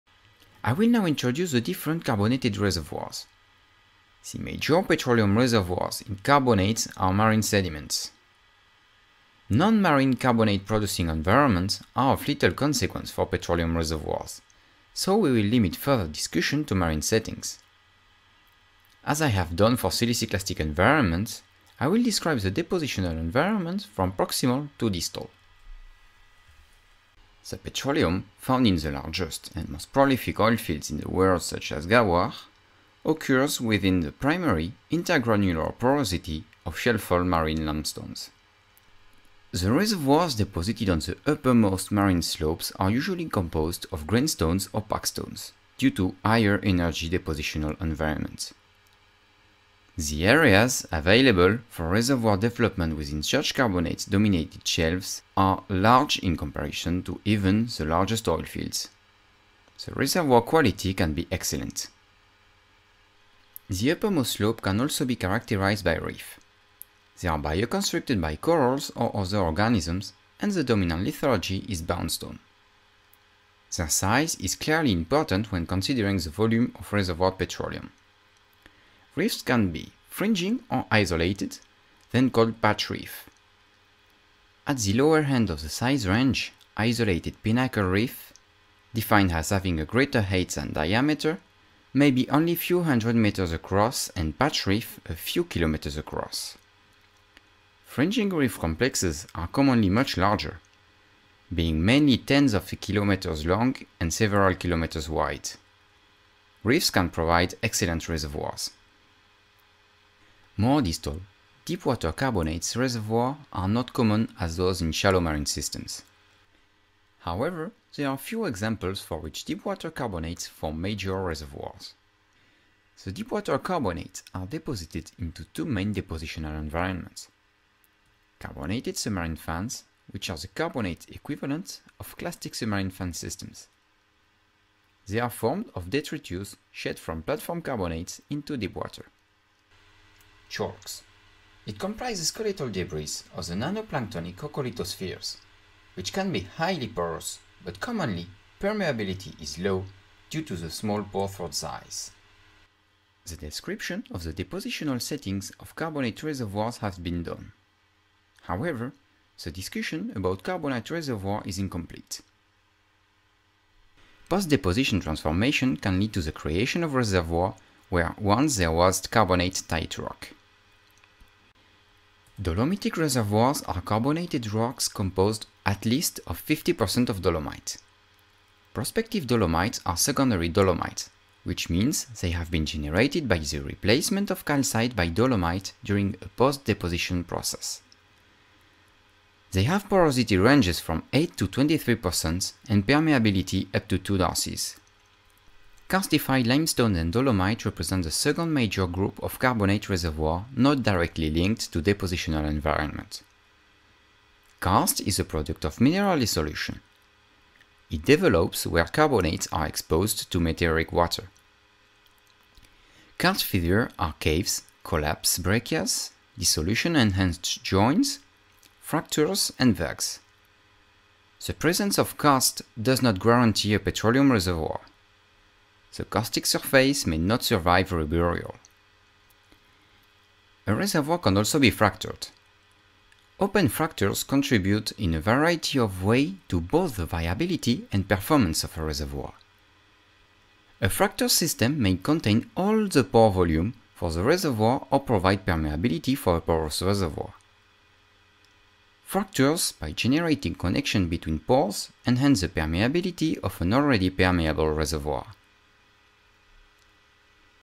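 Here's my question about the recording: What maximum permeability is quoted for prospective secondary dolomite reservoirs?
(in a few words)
2 darcies.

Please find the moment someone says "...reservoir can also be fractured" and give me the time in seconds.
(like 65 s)
230 s.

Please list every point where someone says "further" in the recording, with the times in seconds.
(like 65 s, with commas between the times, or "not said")
15 s.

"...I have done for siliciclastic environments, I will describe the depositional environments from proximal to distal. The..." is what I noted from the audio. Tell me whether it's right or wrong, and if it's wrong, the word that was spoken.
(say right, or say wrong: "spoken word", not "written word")
right.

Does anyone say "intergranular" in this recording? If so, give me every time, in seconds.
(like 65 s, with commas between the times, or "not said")
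34 s.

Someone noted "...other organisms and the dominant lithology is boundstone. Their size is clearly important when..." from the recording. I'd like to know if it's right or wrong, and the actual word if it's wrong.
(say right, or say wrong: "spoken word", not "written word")
right.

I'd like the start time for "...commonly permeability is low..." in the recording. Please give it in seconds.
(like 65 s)
147 s.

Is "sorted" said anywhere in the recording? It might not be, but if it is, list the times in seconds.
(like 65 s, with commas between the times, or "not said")
not said.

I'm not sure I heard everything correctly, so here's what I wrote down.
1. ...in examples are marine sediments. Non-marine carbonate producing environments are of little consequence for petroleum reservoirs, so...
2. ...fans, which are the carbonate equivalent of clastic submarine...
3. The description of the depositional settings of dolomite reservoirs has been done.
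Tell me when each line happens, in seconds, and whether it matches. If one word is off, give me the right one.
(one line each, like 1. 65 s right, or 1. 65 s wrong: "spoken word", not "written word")
1. 6 s wrong: "carbonates", not "examples"
2. 129 s right
3. 153 s wrong: "carbonate", not "dolomite".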